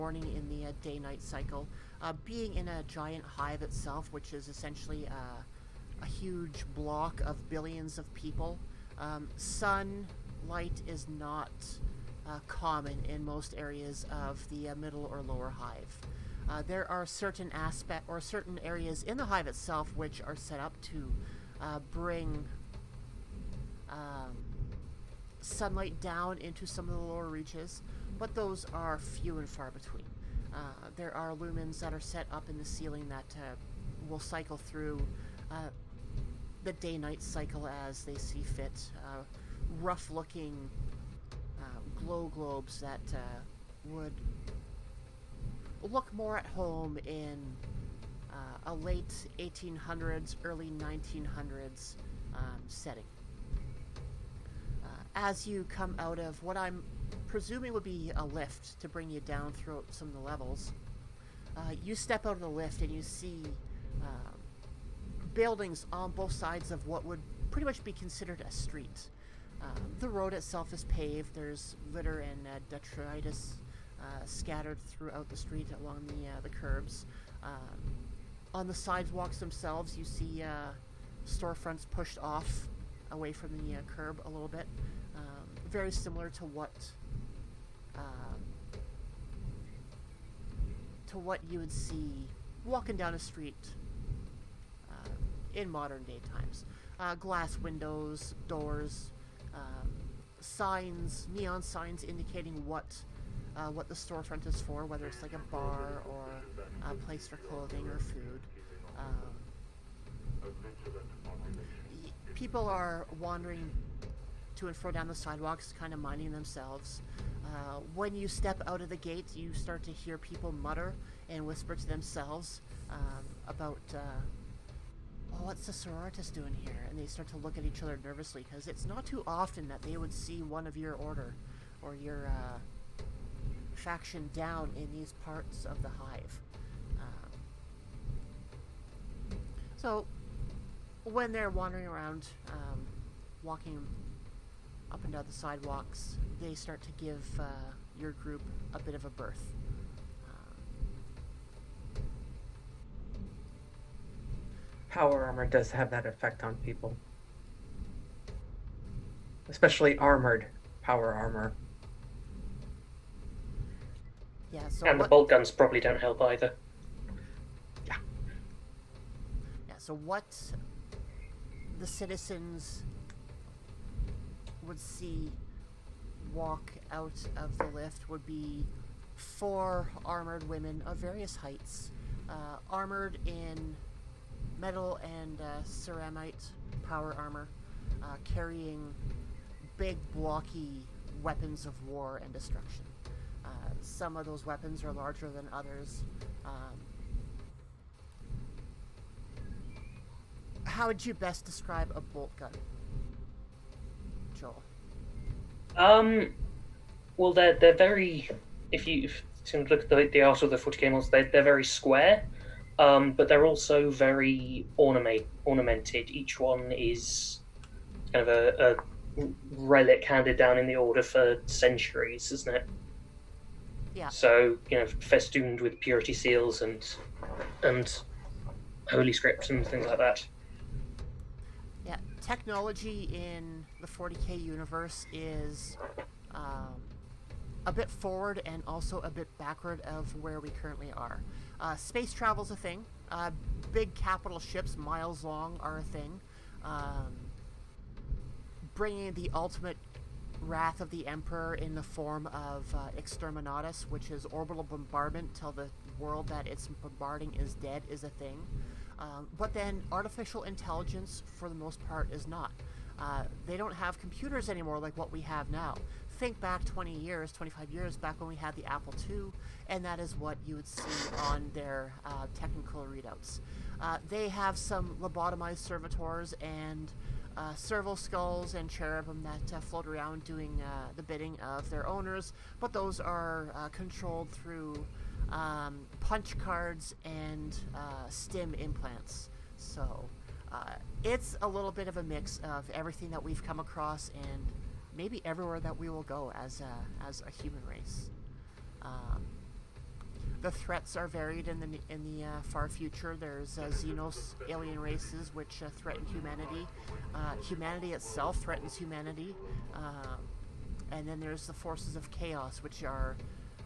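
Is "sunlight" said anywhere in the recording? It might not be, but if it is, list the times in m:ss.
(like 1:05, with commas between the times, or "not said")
0:09, 0:25.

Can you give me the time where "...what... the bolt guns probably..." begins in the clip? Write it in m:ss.
2:44.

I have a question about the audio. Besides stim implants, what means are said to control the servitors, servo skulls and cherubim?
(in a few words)
Punch cards.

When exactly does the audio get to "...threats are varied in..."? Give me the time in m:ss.
5:00.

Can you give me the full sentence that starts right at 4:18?
Um, but then artificial intelligence, for the most part, is not.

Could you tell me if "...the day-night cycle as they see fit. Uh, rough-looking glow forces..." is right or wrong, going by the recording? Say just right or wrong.
wrong.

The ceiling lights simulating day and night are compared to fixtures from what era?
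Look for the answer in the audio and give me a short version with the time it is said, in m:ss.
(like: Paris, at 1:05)
Late 1800s, early 1900s, at 0:48.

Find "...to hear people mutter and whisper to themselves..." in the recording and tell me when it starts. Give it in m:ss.
1:59.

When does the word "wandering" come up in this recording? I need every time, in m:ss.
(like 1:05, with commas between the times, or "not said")
1:53, 2:21.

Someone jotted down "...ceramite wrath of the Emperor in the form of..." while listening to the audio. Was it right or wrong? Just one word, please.
wrong.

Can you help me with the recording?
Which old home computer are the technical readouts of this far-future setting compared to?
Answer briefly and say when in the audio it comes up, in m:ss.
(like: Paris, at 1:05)
Apple II, at 4:28.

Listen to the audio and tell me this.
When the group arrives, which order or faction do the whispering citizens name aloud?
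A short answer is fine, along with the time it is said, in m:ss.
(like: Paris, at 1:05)
Sororitas, at 2:05.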